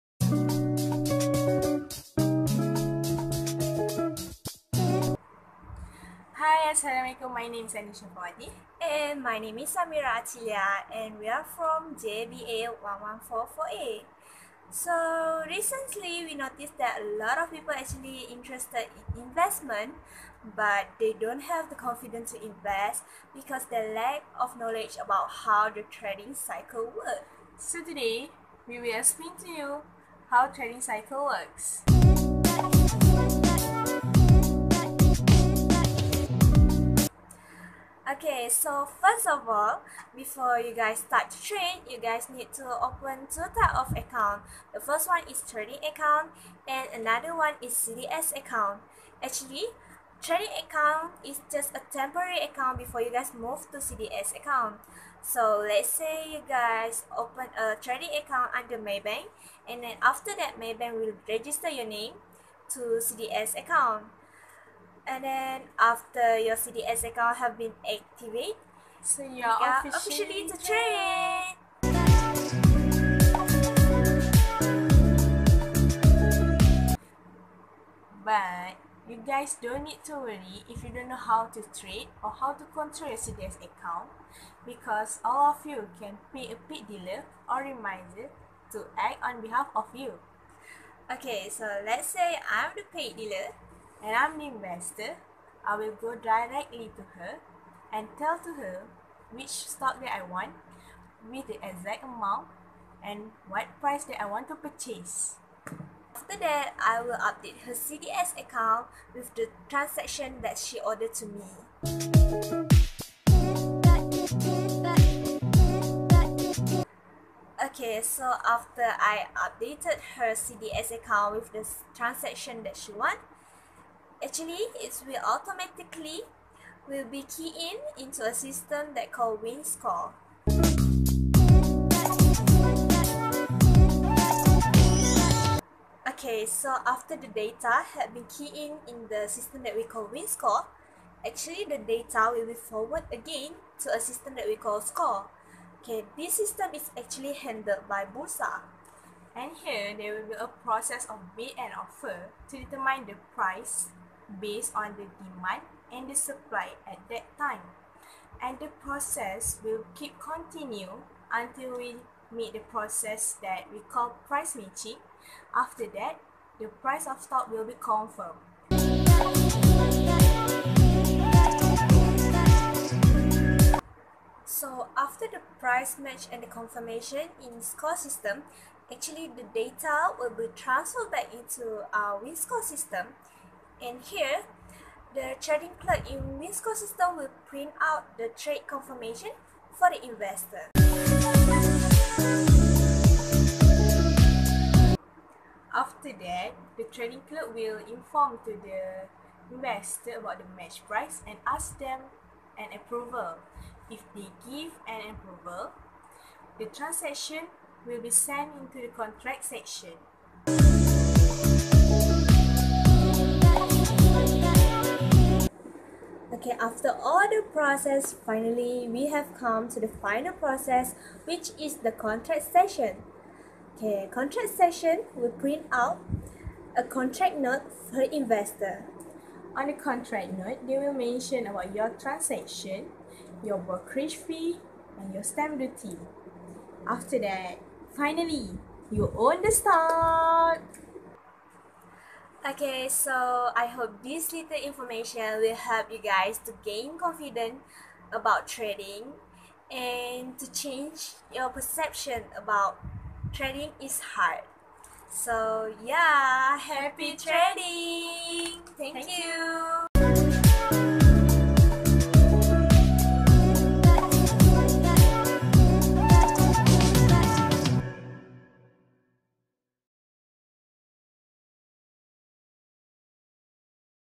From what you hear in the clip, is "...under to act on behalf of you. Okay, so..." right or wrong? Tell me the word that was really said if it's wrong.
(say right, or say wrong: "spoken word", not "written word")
wrong: "remisier", not "under".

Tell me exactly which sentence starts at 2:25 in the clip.
Okay, this system is actually handled by Bursa.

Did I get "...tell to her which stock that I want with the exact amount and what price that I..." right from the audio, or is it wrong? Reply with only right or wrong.
right.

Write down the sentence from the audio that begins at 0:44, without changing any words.
The first one is trading account and another one is CDS account.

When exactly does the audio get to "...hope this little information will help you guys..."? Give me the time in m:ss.
4:03.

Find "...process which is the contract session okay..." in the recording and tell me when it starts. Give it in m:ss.
3:40.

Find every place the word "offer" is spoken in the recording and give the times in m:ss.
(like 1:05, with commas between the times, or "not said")
2:31.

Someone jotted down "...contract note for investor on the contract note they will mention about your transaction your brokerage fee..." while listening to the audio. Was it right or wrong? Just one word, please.
right.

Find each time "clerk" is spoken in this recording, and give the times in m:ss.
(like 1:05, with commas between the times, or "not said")
3:05, 3:17.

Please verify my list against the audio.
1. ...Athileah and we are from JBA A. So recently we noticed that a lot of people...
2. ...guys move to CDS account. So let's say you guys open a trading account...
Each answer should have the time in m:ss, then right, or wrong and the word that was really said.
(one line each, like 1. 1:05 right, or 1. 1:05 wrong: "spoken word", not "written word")
1. 0:10 right
2. 0:53 right.